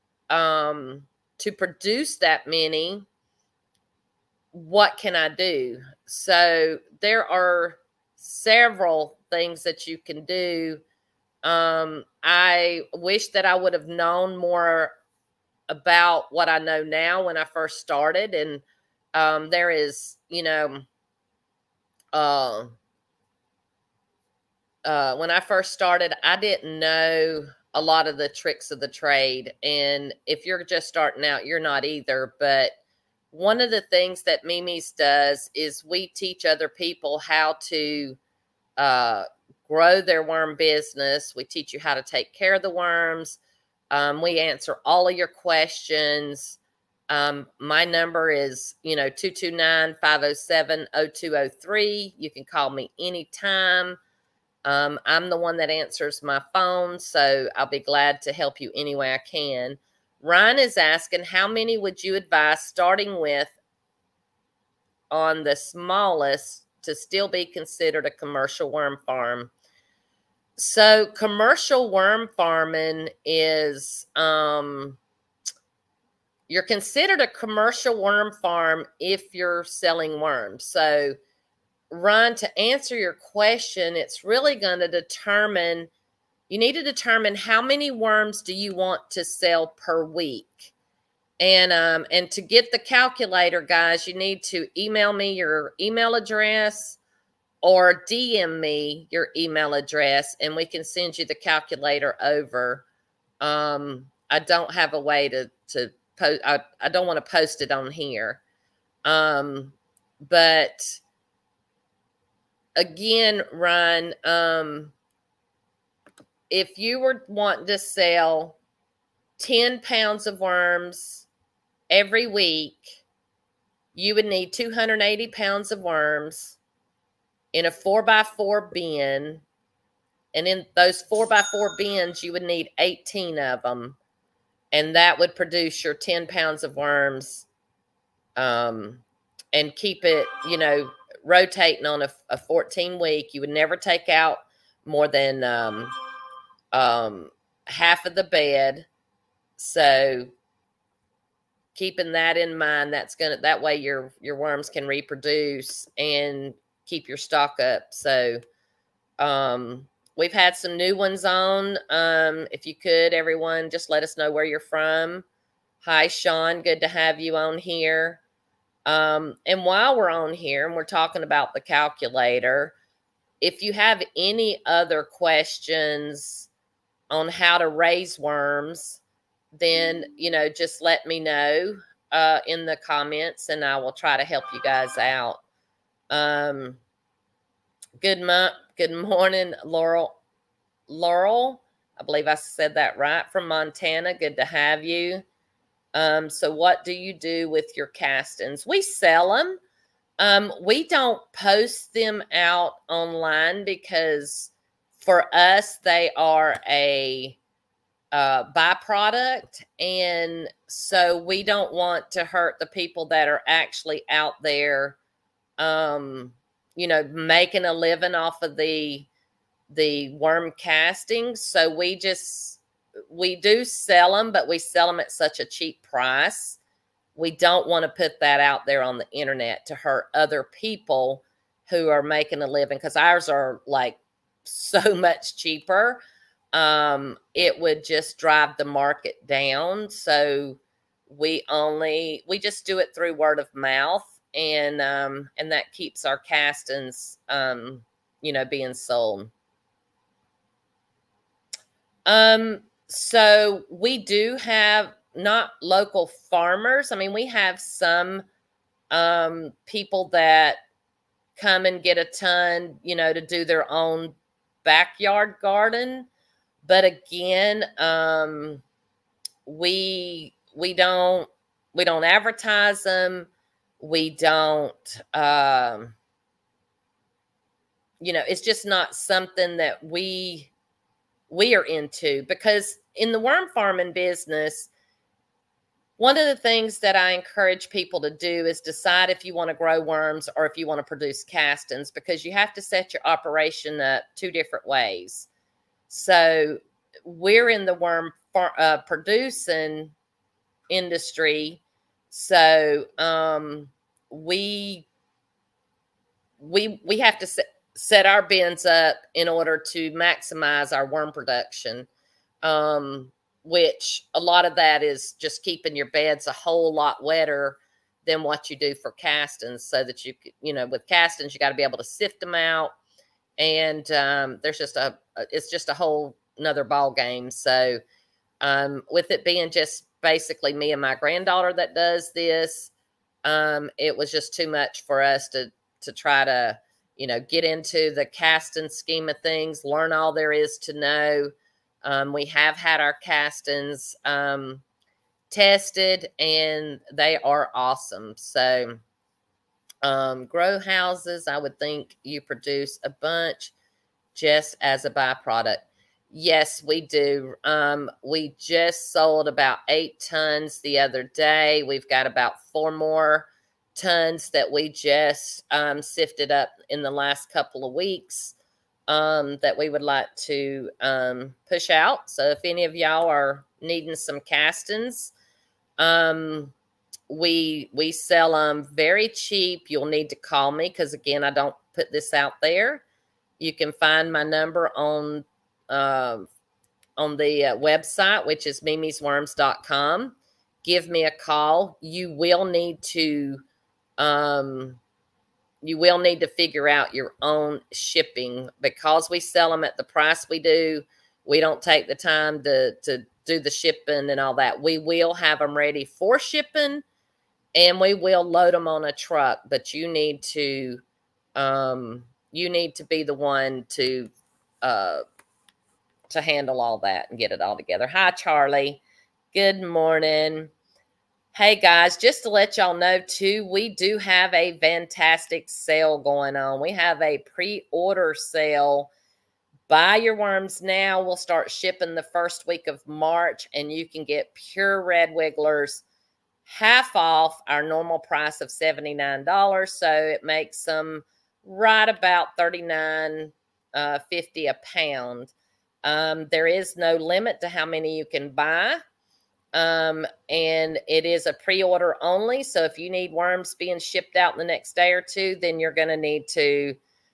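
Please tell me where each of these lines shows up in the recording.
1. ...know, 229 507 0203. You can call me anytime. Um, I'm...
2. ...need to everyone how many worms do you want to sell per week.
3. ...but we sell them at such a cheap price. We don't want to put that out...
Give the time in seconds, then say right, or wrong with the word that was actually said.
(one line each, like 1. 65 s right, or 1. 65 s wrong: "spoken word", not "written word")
1. 48 s right
2. 86 s wrong: "determine", not "everyone"
3. 224 s right.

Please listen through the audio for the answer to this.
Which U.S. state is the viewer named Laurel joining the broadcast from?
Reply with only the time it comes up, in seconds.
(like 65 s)
193 s.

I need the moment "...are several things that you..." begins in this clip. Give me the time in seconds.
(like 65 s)
7 s.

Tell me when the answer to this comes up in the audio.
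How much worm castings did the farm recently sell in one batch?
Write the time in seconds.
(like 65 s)
359 s.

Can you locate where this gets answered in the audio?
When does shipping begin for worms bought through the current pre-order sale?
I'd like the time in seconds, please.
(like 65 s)
432 s.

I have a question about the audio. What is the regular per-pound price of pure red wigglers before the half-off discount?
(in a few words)
$79.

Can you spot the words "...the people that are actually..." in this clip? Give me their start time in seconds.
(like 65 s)
212 s.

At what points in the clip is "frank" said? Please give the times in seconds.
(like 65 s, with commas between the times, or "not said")
not said.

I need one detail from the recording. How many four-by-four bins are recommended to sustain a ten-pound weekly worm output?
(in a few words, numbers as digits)
18.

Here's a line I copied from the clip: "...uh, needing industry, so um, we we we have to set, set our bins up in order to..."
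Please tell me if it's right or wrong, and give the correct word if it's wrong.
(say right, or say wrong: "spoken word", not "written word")
wrong: "producing", not "needing".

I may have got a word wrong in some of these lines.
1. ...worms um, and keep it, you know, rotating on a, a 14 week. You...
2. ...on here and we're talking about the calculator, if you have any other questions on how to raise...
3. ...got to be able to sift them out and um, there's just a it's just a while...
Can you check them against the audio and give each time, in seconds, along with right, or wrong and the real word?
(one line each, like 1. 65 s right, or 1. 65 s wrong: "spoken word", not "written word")
1. 136 s right
2. 170 s right
3. 321 s wrong: "whole", not "while".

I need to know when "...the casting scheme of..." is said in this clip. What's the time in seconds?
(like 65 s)
337 s.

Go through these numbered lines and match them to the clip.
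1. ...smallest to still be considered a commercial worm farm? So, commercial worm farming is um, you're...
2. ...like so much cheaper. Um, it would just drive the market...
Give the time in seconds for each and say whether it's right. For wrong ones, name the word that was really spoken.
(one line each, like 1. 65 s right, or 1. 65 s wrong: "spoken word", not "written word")
1. 65 s right
2. 233 s right.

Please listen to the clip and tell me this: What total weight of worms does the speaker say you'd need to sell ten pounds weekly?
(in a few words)
280 pounds.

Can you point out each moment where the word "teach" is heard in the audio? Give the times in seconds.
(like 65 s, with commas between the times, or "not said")
36 s, 41 s.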